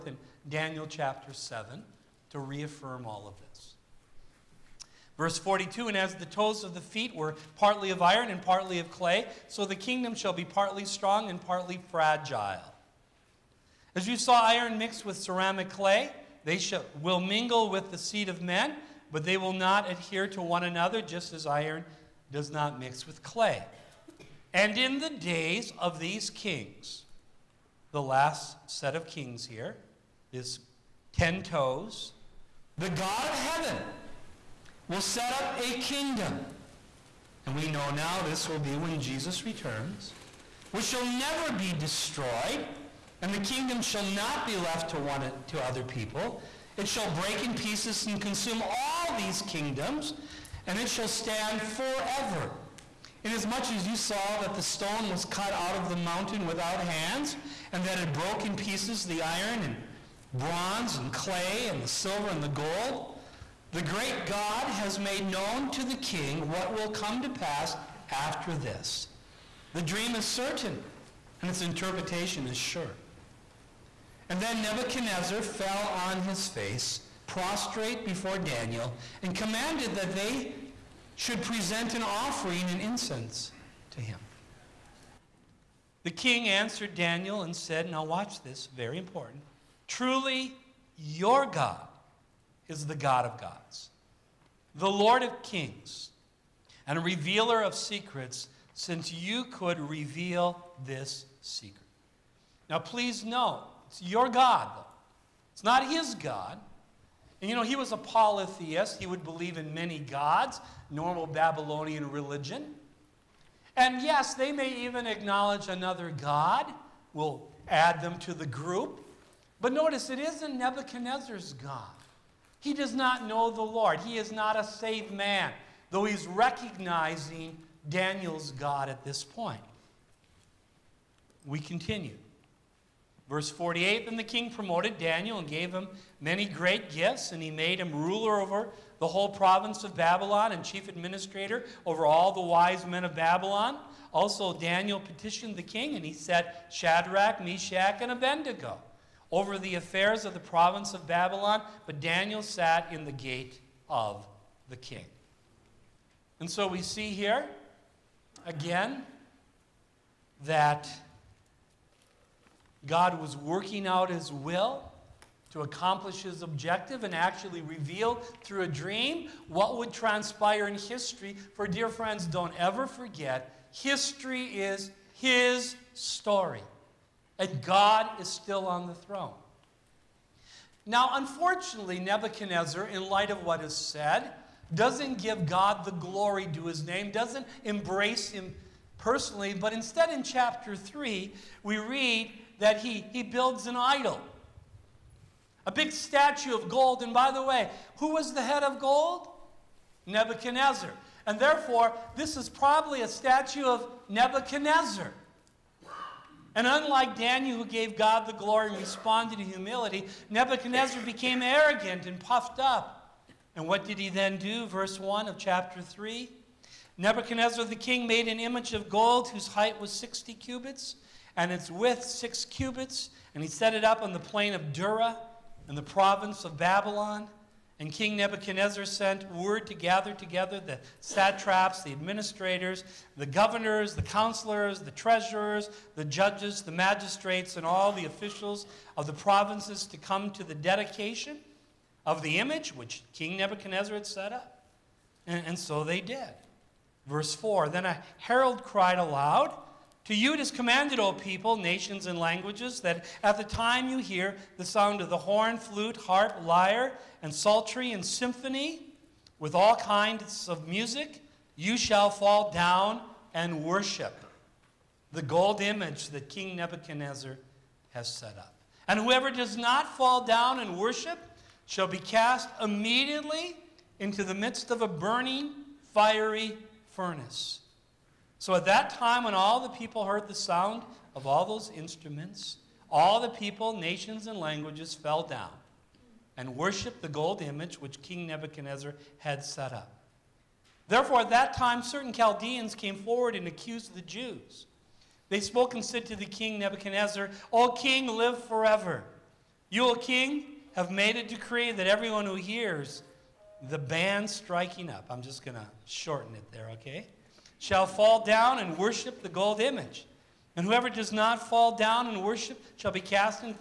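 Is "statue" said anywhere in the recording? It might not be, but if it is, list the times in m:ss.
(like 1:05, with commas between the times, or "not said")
3:15, 3:23.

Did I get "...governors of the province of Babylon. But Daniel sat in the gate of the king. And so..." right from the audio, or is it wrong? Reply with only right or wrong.
wrong.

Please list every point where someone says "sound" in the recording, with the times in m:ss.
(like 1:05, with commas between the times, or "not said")
4:14, 4:40.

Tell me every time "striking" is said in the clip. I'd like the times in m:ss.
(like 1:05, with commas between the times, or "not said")
5:04.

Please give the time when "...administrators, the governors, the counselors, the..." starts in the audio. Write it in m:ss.
3:51.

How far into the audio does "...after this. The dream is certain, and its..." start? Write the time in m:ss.
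1:08.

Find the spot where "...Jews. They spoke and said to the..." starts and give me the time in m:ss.
4:54.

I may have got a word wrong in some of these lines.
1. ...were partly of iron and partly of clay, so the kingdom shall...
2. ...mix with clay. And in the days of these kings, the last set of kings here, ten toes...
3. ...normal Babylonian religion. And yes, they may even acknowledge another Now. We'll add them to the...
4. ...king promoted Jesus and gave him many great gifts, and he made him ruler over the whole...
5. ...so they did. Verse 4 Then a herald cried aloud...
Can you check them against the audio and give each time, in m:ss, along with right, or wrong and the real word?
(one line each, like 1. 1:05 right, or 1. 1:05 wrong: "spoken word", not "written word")
1. 0:07 right
2. 0:22 right
3. 1:50 wrong: "God", not "Now"
4. 2:14 wrong: "Daniel", not "Jesus"
5. 4:05 right.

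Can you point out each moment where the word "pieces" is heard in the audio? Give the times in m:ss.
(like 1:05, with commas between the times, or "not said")
0:47, 0:58.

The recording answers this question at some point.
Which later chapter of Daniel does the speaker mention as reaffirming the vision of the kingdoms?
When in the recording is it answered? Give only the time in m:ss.
0:00.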